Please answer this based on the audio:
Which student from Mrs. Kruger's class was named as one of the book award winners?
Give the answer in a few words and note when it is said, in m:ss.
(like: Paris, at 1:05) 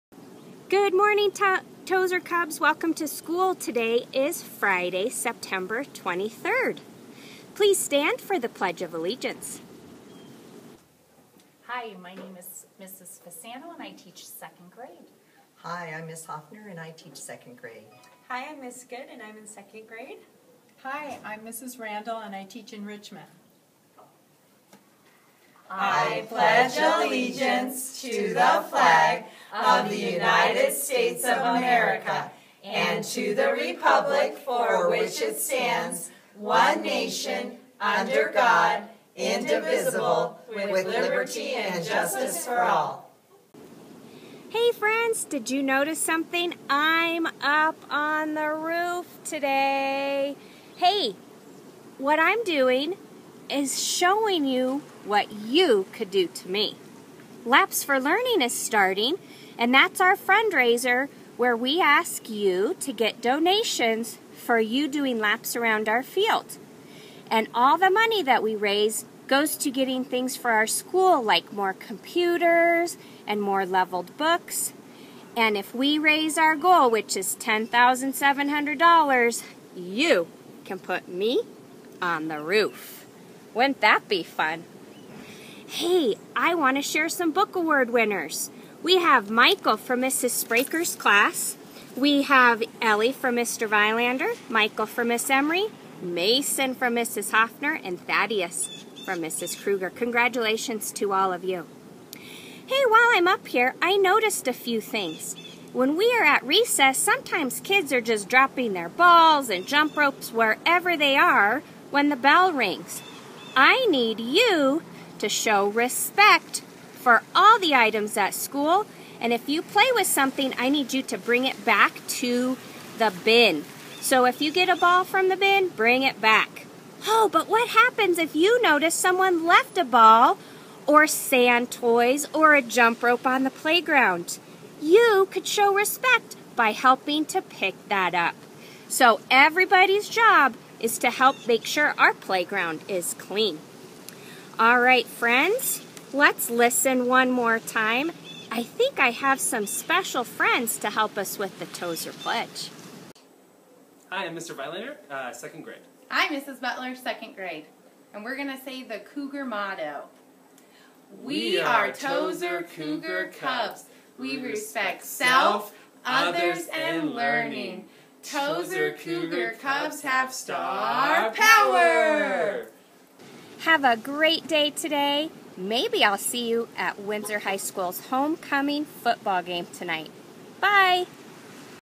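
Thaddeus, at 1:38.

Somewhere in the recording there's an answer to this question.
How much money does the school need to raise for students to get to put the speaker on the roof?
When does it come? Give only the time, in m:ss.
1:17.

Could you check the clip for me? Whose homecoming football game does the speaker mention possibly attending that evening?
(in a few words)
Windsor High School.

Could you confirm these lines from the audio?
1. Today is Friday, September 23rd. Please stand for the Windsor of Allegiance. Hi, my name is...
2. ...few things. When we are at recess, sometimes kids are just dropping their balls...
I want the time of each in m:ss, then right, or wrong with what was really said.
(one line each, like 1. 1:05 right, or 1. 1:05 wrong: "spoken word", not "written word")
1. 0:03 wrong: "Pledge", not "Windsor"
2. 1:44 right.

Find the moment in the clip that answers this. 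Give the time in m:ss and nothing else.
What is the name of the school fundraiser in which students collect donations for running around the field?
0:57.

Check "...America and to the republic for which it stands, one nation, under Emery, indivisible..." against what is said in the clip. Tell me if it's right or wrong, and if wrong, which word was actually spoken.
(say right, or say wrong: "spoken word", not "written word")
wrong: "God", not "Emery".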